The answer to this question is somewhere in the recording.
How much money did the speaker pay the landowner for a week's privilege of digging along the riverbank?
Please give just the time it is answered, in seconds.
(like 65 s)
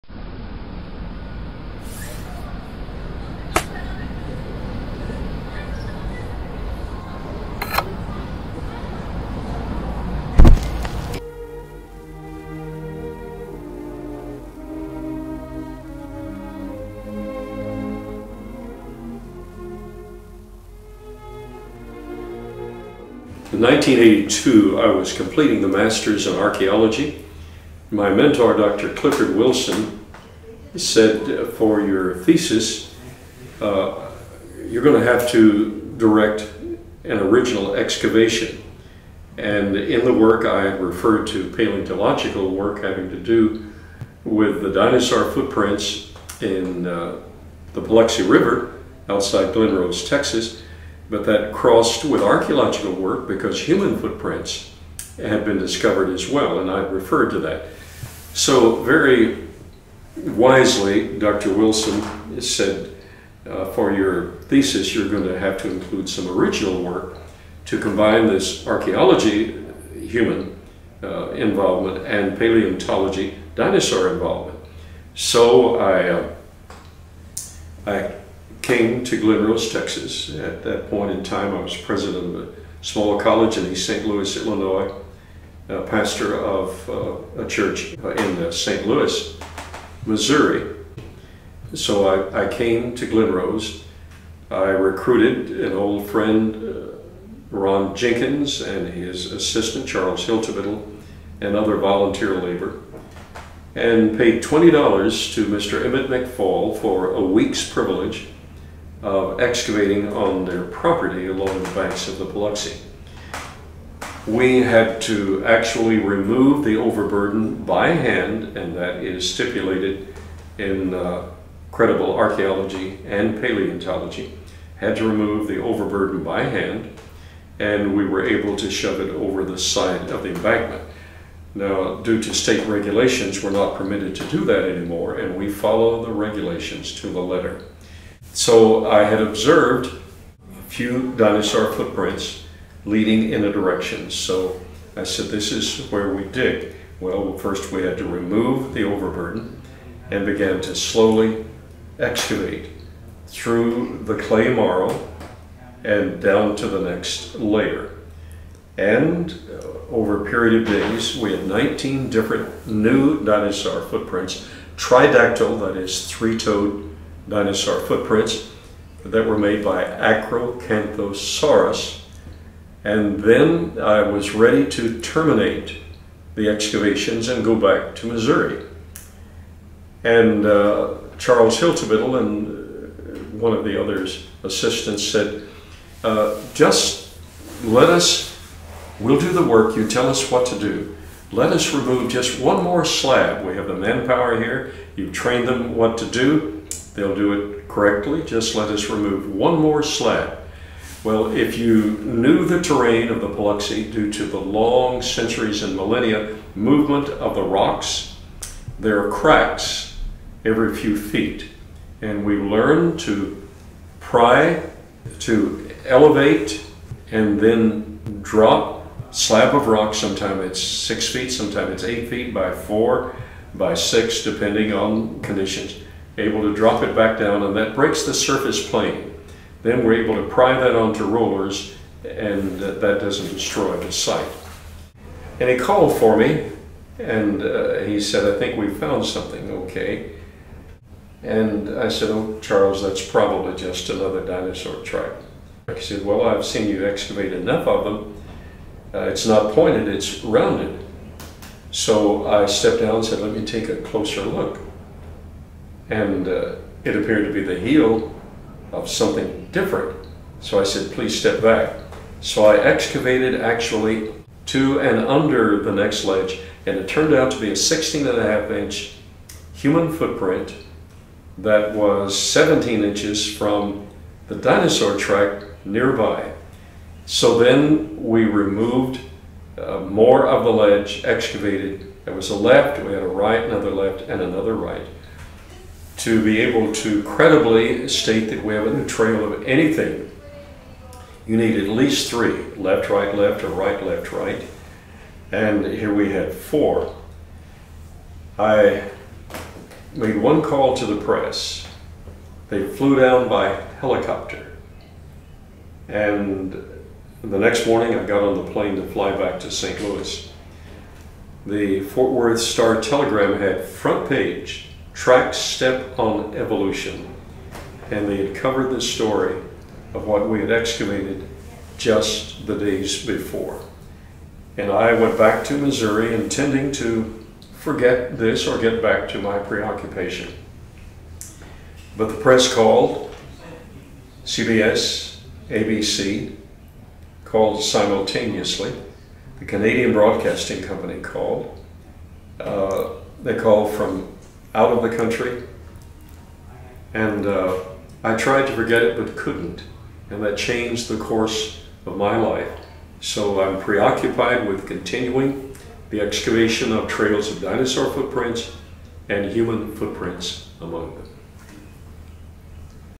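104 s.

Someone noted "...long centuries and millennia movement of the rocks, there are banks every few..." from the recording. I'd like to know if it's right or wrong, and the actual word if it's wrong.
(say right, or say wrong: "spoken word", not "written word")
wrong: "cracks", not "banks".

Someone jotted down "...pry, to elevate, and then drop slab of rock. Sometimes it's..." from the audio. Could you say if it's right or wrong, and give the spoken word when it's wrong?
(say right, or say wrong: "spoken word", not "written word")
right.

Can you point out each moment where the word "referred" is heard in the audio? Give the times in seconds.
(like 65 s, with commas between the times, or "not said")
40 s, 56 s.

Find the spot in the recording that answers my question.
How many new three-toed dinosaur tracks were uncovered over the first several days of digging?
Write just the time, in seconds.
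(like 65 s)
161 s.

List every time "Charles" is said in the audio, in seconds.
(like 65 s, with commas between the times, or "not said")
99 s, 181 s, 242 s.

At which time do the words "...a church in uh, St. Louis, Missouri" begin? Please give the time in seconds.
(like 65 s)
87 s.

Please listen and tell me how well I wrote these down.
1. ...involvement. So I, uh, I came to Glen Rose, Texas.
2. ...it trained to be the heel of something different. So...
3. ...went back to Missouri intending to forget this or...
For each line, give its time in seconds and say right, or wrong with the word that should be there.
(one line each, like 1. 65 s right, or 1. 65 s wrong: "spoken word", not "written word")
1. 74 s right
2. 256 s wrong: "appeared", not "trained"
3. 324 s right.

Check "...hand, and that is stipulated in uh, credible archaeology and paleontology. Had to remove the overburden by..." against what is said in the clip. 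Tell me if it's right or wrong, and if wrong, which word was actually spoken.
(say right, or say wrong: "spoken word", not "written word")
right.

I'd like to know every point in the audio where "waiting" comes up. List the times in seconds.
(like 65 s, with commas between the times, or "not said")
not said.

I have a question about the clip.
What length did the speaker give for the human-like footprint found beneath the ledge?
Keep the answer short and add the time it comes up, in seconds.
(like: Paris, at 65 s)
16 and a half inches, at 267 s.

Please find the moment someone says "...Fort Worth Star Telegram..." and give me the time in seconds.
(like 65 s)
311 s.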